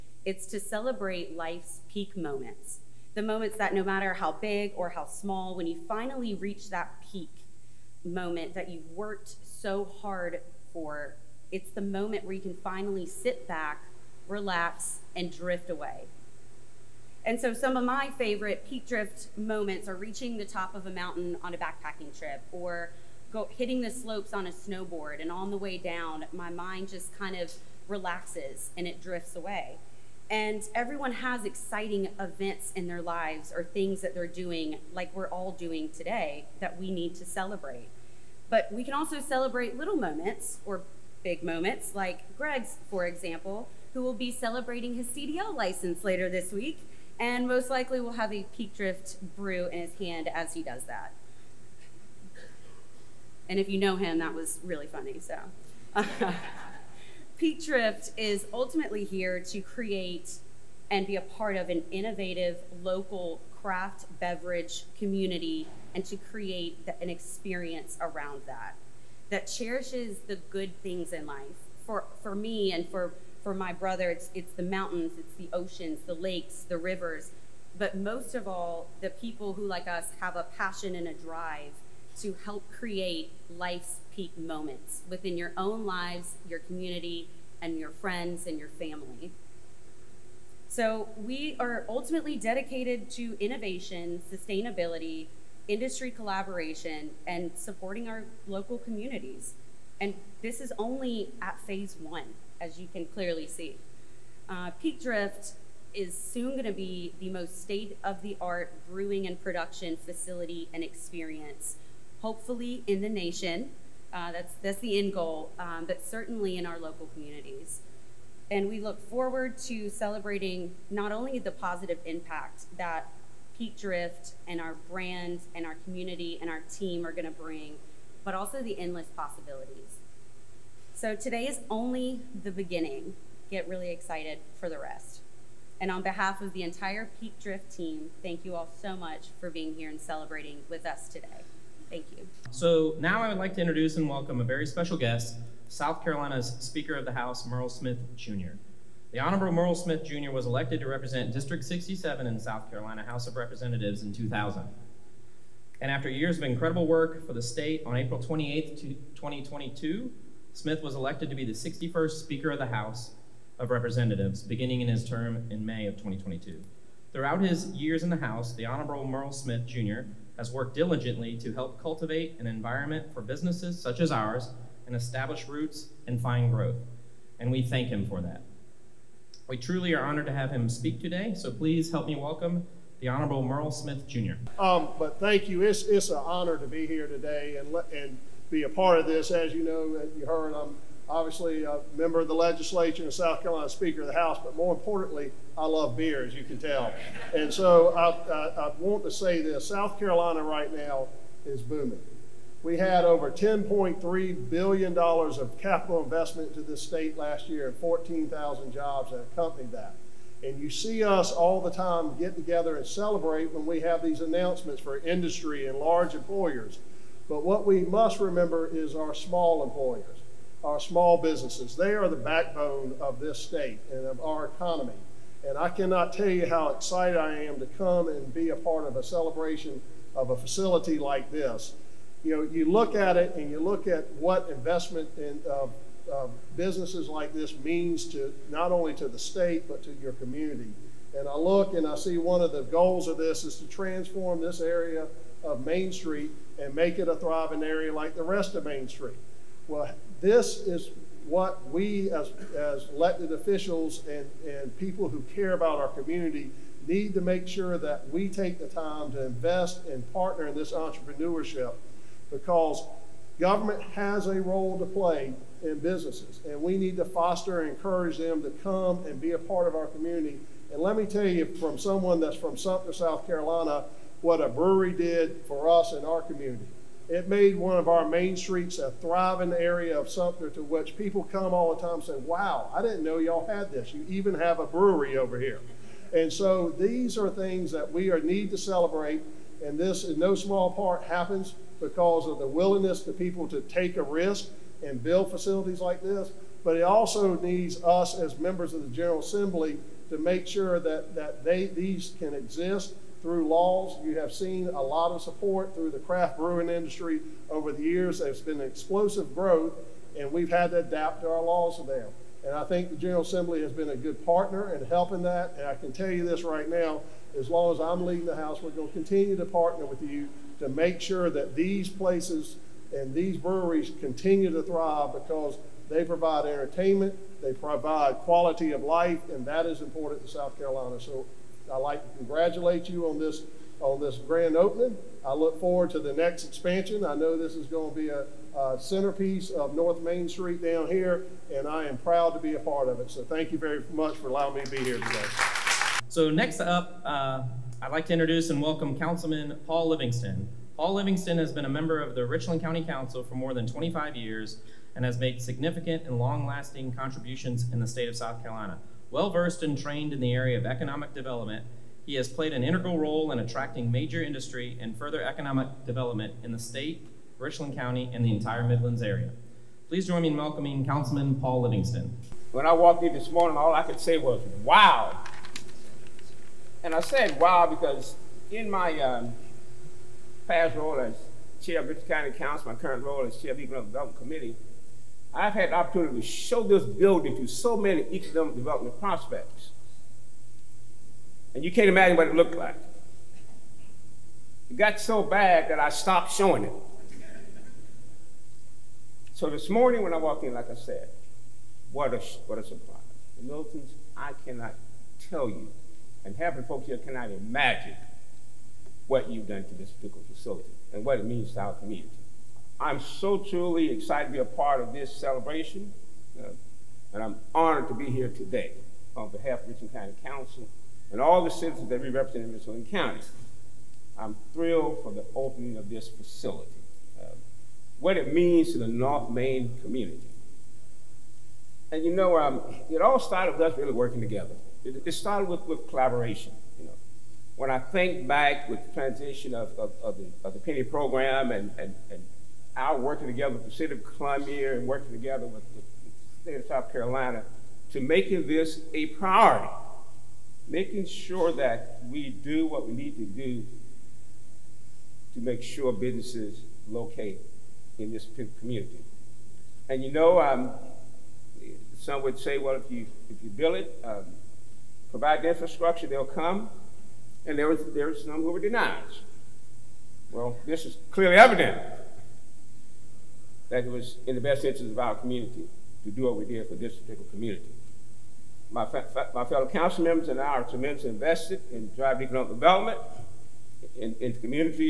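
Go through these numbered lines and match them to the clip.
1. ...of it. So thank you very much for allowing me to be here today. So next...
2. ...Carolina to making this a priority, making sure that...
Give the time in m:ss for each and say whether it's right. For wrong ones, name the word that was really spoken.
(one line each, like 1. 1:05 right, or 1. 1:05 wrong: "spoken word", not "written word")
1. 5:42 right
2. 7:26 right.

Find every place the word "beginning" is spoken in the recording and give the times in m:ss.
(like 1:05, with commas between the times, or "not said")
2:12, 2:44.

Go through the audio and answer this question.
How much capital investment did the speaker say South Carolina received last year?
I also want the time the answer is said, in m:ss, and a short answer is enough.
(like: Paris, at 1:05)
$10.3 billion, at 3:23.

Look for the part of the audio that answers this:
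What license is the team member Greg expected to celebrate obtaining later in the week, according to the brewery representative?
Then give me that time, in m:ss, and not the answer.
0:45.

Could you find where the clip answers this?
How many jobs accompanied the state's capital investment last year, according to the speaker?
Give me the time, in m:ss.
3:27.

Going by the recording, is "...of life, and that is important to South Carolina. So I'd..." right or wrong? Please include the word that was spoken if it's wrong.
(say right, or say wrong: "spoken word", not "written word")
right.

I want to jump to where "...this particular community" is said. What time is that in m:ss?
7:56.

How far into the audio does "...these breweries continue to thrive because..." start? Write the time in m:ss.
5:23.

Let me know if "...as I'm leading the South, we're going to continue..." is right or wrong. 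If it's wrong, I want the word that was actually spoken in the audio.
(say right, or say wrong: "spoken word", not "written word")
wrong: "House", not "South".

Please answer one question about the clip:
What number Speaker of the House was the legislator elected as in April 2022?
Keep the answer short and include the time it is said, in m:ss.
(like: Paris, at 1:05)
61st, at 2:41.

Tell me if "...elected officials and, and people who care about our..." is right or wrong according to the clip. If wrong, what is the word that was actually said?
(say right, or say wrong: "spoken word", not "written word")
right.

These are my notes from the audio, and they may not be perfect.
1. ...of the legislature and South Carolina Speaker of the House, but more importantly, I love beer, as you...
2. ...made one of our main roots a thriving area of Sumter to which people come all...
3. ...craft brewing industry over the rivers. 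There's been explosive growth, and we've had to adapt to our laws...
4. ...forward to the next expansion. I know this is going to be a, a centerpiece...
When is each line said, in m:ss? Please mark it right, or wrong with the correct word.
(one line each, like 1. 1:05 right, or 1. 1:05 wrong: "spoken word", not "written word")
1. 3:12 right
2. 4:37 wrong: "streets", not "roots"
3. 5:05 wrong: "years", not "rivers"
4. 5:35 right.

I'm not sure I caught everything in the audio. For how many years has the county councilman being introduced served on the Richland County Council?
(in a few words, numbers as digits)
25 years.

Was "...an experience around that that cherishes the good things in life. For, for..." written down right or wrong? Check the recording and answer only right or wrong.
right.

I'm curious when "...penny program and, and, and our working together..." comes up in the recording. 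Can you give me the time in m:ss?
7:20.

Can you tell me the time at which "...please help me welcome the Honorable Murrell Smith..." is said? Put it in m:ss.
3:01.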